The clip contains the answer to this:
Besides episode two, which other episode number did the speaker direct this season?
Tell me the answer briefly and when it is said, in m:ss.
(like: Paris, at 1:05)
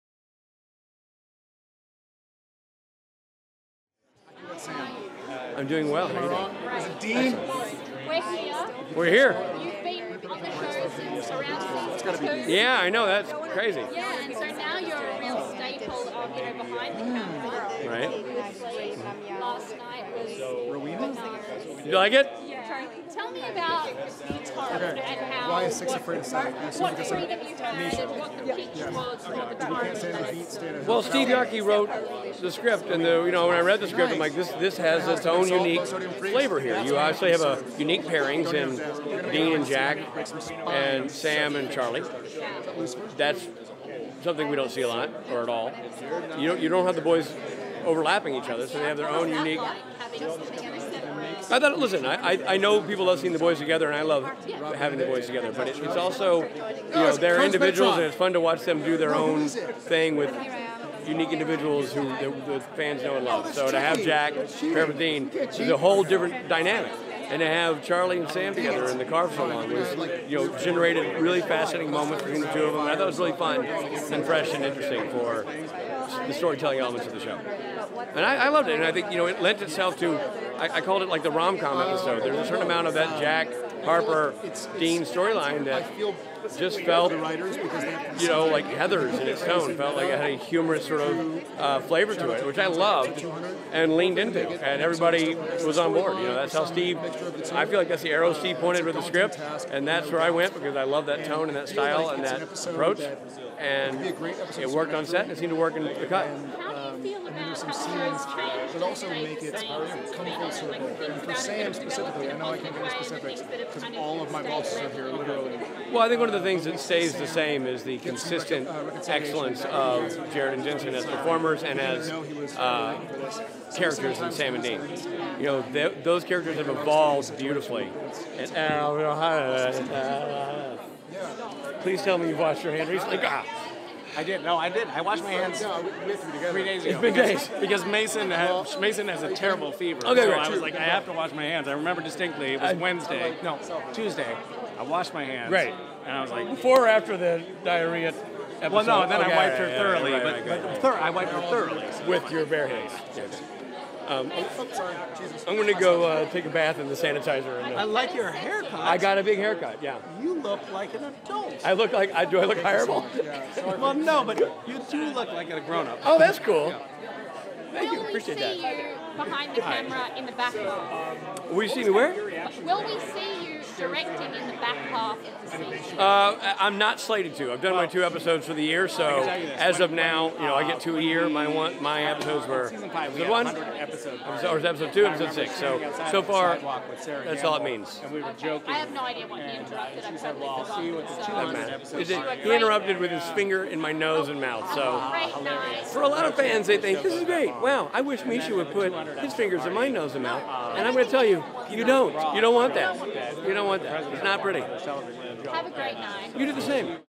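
6, at 3:05.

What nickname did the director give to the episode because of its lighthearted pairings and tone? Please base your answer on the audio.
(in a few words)
the rom-com episode.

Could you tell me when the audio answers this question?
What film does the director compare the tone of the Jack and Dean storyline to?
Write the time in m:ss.
1:28.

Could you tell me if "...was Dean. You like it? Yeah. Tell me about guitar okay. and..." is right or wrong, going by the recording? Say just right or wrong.
wrong.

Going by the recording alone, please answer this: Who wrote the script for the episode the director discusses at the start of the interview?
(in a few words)
Steve Yockey.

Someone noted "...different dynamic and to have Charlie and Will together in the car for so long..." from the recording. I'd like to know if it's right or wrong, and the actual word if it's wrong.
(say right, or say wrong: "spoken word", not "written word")
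wrong: "Sam", not "Will".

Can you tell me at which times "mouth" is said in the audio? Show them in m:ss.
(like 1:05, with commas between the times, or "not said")
3:14, 3:20.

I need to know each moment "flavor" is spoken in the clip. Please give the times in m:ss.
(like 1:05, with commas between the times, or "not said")
0:35, 1:31.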